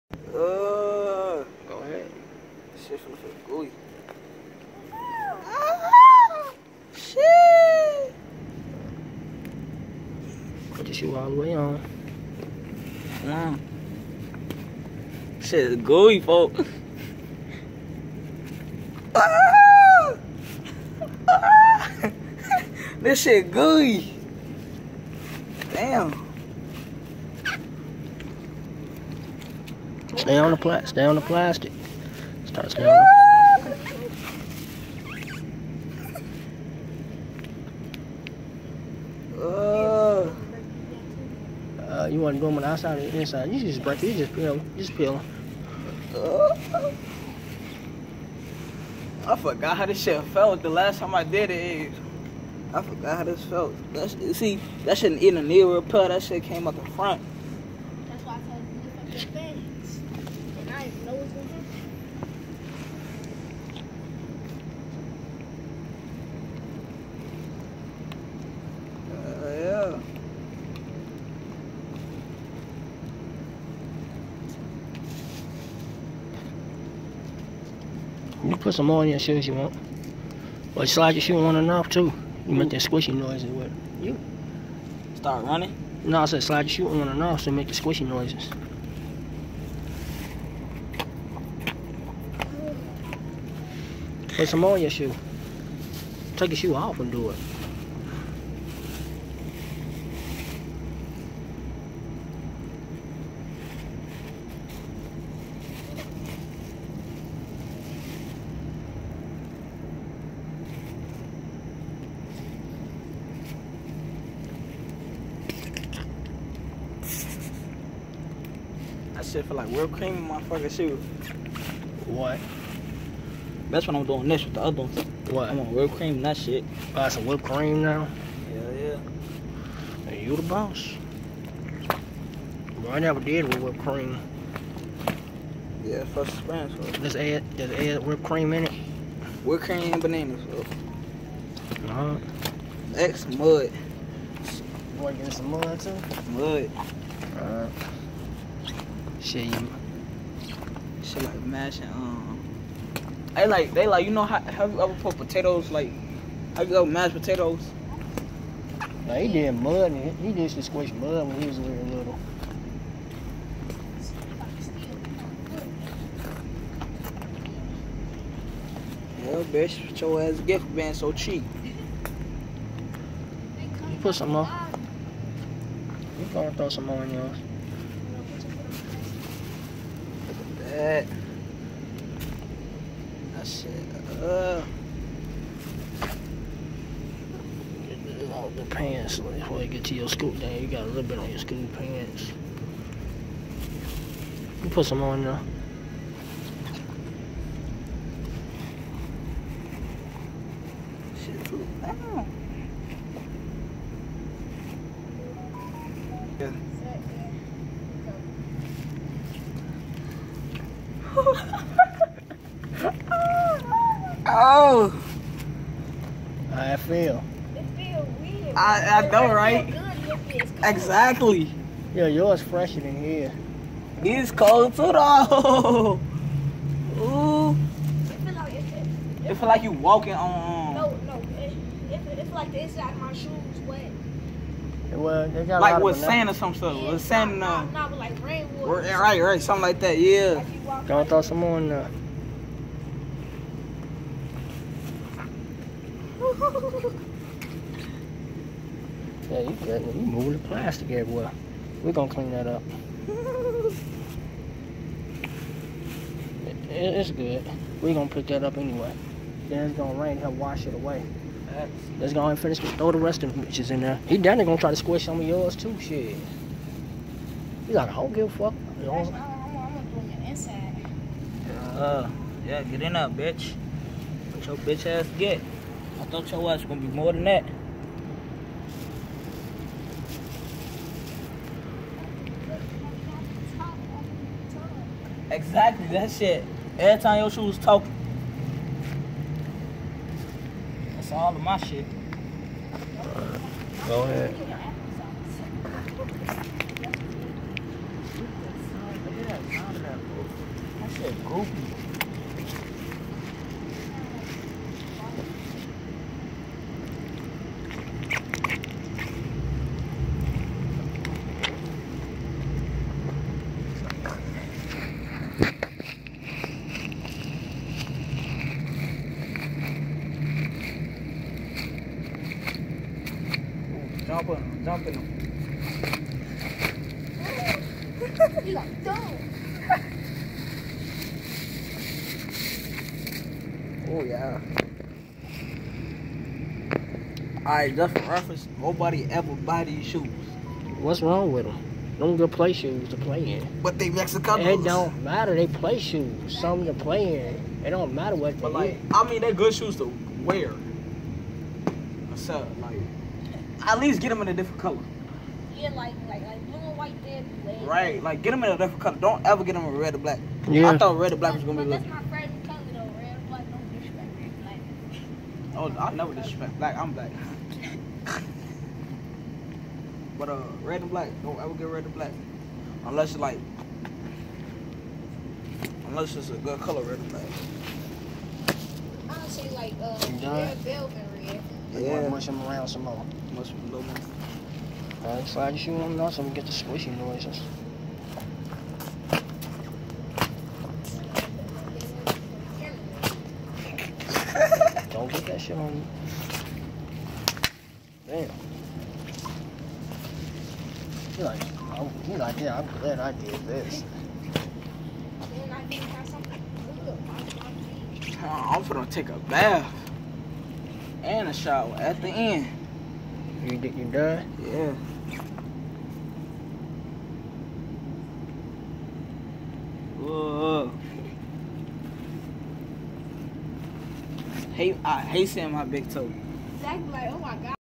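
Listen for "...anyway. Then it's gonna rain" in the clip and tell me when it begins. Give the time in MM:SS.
04:18.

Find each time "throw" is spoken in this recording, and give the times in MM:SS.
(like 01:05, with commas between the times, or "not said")
02:56, 04:01, 04:22.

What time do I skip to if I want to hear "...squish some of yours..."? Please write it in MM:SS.
04:24.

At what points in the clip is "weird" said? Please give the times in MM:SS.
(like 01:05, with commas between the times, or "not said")
03:38.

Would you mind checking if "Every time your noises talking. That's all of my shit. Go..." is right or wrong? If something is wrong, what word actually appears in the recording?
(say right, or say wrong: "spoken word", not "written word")
wrong: "shoes", not "noises".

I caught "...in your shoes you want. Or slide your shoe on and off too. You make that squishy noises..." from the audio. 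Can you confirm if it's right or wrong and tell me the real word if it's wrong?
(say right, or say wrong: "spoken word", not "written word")
right.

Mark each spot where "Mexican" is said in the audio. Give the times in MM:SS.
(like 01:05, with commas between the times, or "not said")
05:43.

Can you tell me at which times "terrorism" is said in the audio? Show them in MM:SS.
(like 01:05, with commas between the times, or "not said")
not said.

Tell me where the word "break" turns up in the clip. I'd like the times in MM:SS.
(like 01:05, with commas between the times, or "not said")
00:43.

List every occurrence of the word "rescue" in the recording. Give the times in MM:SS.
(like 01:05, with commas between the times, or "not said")
not said.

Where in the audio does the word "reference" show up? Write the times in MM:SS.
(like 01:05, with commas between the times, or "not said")
05:38.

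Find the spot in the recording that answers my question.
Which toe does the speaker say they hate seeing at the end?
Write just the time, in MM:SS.
07:05.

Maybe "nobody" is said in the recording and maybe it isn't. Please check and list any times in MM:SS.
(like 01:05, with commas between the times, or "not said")
05:38.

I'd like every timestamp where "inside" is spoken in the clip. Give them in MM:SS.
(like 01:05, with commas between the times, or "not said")
00:43, 03:52, 04:30.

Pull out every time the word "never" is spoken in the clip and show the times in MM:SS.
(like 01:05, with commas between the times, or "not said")
02:12, 06:05.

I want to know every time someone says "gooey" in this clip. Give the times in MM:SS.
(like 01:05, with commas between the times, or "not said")
00:15, 00:23.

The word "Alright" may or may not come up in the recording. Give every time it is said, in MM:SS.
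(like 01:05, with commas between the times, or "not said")
05:37, 06:25.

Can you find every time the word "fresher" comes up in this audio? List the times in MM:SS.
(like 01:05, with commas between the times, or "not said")
03:42.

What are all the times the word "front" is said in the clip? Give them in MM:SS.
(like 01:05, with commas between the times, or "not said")
00:56.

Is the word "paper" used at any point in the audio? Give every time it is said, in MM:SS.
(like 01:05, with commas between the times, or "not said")
not said.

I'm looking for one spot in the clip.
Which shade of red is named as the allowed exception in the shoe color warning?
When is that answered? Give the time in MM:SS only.
06:20.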